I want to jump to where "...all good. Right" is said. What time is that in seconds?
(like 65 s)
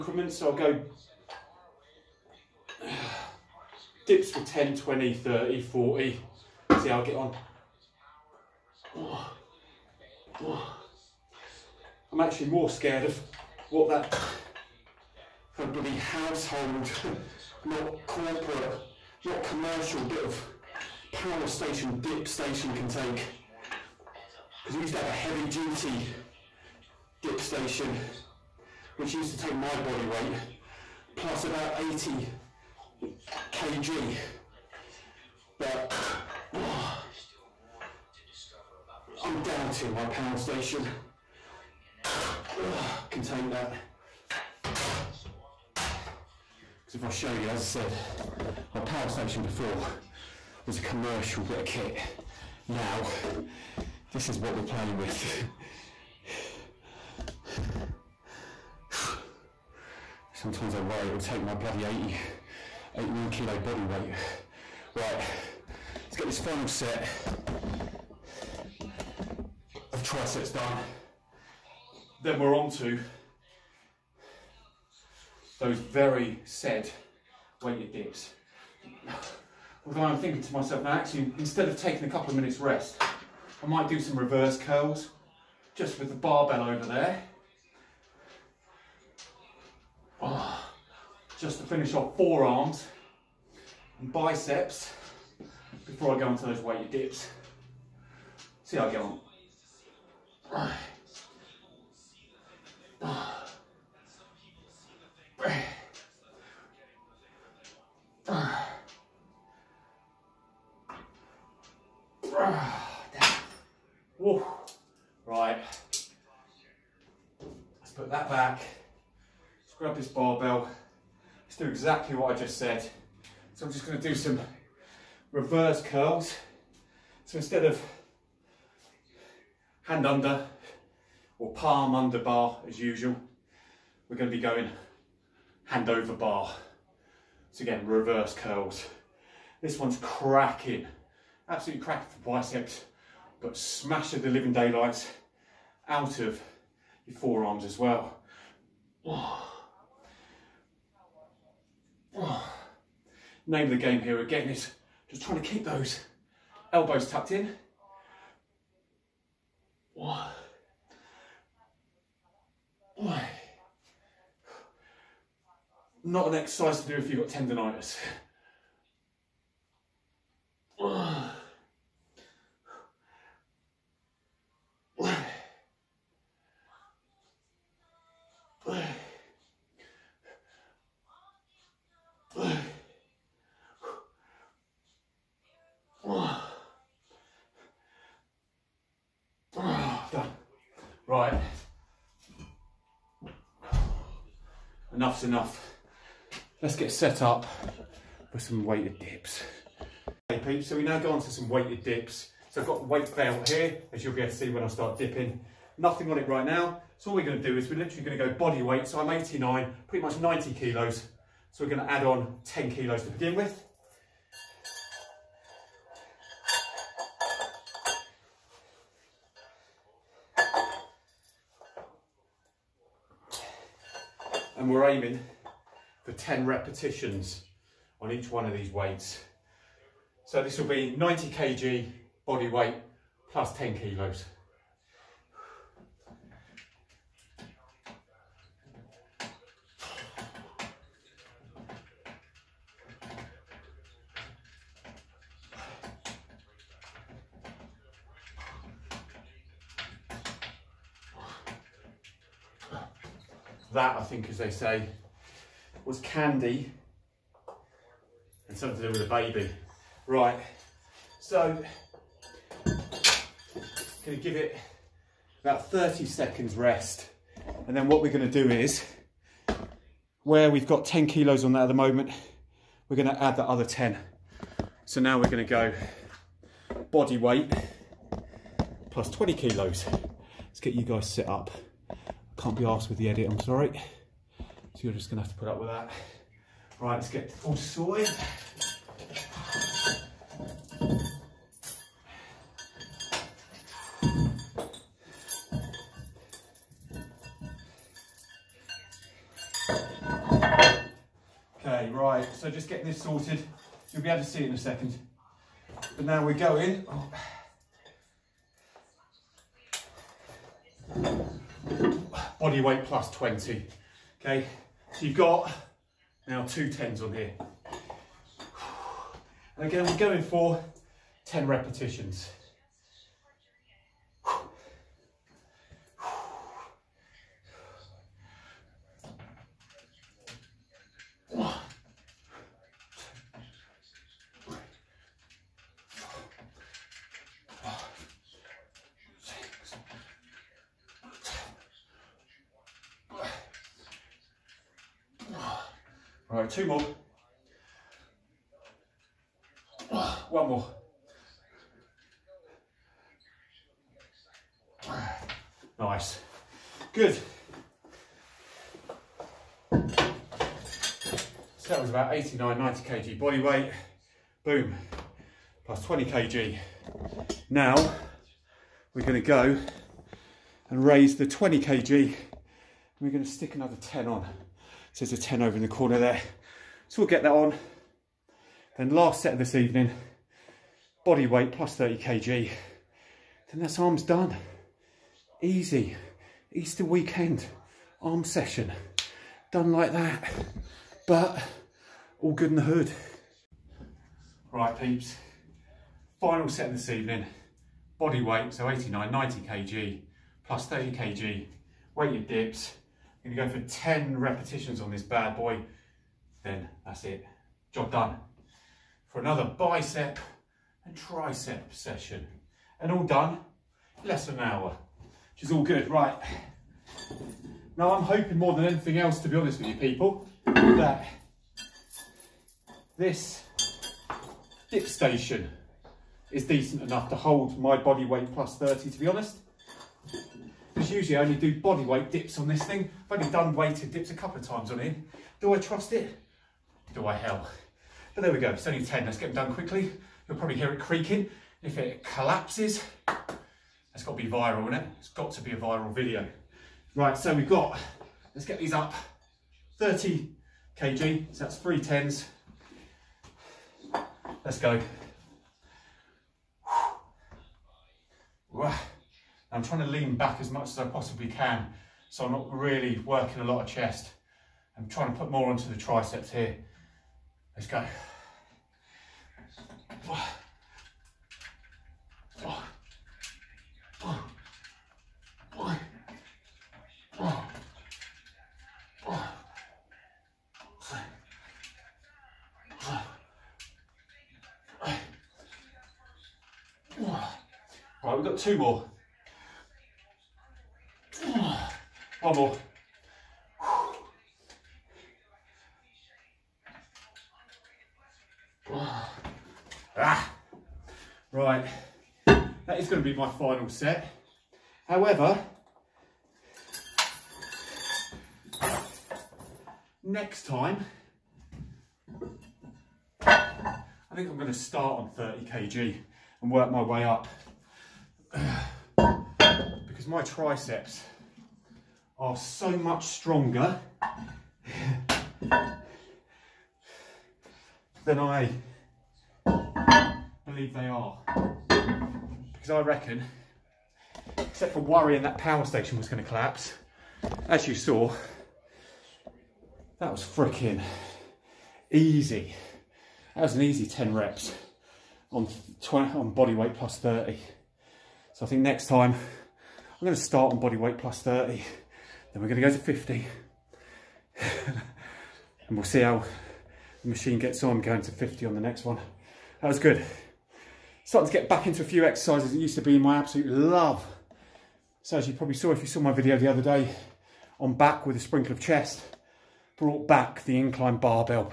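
415 s.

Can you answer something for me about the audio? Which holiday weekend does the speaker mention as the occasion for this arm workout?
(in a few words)
Easter.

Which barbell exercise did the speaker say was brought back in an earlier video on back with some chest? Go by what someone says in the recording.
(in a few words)
incline barbell.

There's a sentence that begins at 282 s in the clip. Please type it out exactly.
Can't be asked with the edit, I'm sorry.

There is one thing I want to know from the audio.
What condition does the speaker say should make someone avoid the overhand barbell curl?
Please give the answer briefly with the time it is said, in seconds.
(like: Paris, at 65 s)
tendonitis, at 167 s.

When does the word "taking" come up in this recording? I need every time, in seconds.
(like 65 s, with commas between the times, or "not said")
81 s.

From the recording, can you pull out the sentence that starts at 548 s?
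So I think next time I'm going to start on body weight plus 30.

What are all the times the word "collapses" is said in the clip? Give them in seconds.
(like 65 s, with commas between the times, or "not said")
442 s, 536 s.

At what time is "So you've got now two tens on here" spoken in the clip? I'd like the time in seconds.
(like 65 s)
314 s.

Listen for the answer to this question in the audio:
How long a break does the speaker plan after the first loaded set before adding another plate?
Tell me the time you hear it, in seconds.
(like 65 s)
265 s.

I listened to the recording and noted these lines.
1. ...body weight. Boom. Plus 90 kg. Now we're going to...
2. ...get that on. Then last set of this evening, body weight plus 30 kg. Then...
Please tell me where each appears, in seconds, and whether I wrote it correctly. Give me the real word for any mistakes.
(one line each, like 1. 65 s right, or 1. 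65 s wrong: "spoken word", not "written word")
1. 363 s wrong: "20", not "90"
2. 377 s right.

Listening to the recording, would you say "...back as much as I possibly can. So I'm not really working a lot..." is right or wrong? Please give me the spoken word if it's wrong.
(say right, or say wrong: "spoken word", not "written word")
right.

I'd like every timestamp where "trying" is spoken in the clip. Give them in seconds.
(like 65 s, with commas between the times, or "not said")
155 s, 459 s, 464 s.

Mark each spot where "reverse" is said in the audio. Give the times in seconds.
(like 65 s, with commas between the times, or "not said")
84 s, 125 s, 137 s.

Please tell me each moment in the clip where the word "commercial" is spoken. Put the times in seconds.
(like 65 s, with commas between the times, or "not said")
19 s, 50 s.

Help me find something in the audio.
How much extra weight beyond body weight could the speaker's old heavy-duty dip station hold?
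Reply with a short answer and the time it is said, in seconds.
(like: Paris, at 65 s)
80 kg, at 31 s.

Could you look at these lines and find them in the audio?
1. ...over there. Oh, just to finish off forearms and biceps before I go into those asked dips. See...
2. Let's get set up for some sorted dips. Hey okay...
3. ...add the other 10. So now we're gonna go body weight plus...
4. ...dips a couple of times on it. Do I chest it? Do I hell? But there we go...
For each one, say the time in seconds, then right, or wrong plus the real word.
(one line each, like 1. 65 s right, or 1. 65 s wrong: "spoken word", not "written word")
1. 86 s wrong: "weighted", not "asked"
2. 196 s wrong: "weighted", not "sorted"
3. 273 s right
4. 433 s wrong: "trust", not "chest".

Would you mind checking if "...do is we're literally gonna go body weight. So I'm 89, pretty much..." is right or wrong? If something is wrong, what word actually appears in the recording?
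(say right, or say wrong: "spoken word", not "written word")
right.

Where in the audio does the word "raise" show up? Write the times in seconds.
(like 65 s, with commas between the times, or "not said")
370 s.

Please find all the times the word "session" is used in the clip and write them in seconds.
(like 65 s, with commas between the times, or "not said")
388 s, 411 s.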